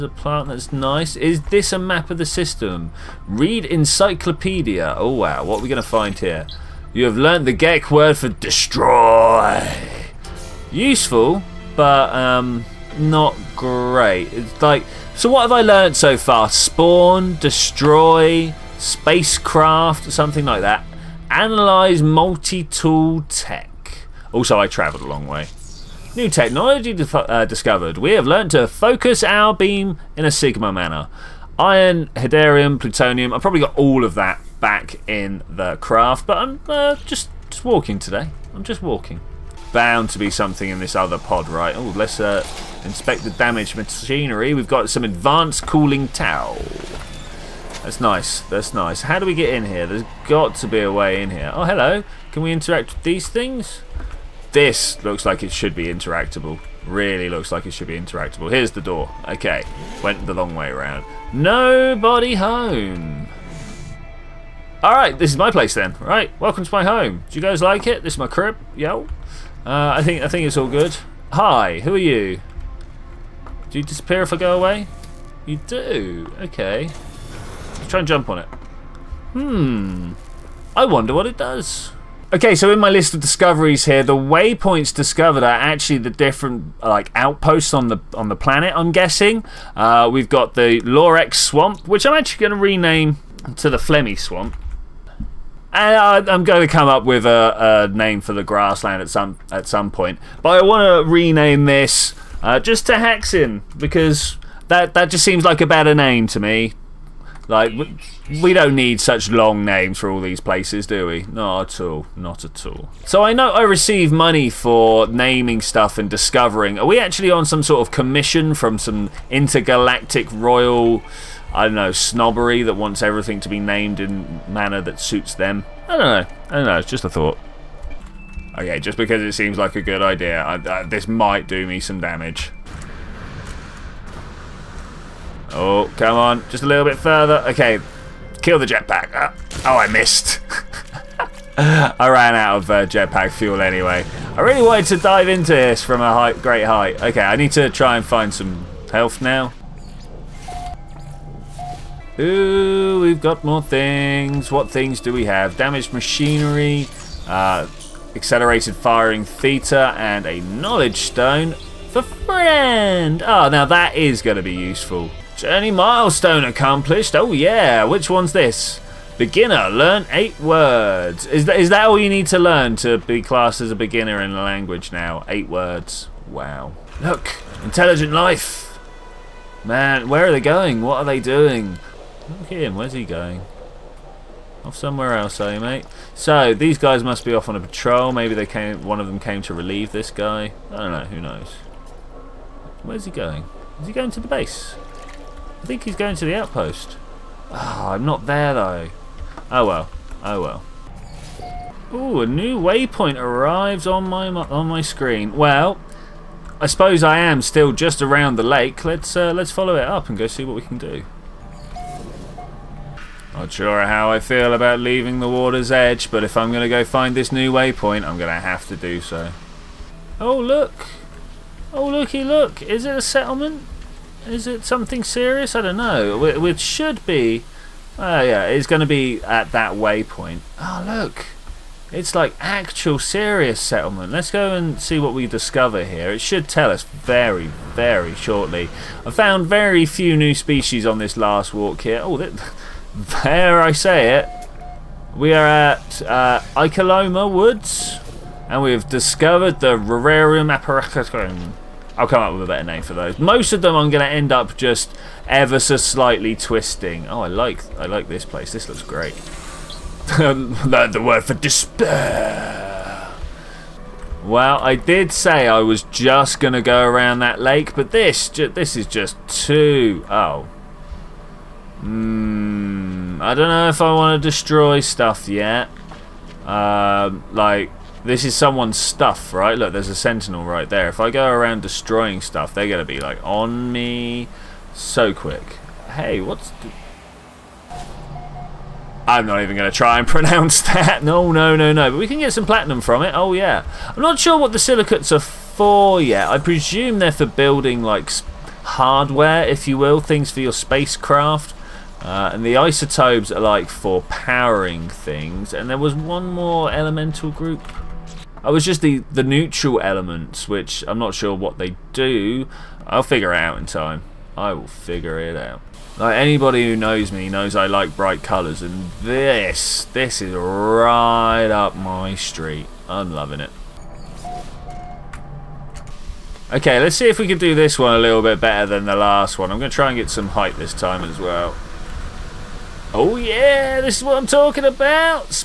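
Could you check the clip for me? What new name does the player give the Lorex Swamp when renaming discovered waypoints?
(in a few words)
Flemmy Swamp.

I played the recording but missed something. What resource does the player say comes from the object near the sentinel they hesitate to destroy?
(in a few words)
Platinum.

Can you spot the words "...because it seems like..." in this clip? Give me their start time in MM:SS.
02:08.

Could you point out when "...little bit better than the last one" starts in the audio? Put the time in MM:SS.
05:27.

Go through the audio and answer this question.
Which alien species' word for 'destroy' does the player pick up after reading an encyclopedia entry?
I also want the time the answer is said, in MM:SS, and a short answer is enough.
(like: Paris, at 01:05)
Gek, at 00:07.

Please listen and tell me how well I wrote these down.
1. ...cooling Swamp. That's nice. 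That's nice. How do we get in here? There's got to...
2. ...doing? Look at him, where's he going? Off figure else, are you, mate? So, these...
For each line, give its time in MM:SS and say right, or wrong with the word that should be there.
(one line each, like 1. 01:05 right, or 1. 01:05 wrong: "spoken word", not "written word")
1. 00:45 wrong: "Tau", not "Swamp"
2. 03:01 wrong: "somewhere", not "figure".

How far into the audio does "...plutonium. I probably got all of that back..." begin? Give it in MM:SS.
00:32.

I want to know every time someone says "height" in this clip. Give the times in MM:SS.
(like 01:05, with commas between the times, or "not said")
02:26, 05:30.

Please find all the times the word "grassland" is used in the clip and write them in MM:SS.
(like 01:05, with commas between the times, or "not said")
01:38.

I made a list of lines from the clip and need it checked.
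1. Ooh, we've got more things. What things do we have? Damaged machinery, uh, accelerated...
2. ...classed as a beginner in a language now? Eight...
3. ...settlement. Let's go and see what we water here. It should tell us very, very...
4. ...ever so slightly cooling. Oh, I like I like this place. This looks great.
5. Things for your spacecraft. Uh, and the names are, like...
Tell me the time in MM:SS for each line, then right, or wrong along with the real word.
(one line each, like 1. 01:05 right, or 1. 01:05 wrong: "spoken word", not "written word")
1. 02:32 right
2. 02:53 right
3. 03:53 wrong: "discover", not "water"
4. 04:15 wrong: "twisting", not "cooling"
5. 04:59 wrong: "isotopes", not "names".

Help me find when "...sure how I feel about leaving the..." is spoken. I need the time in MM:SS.
03:33.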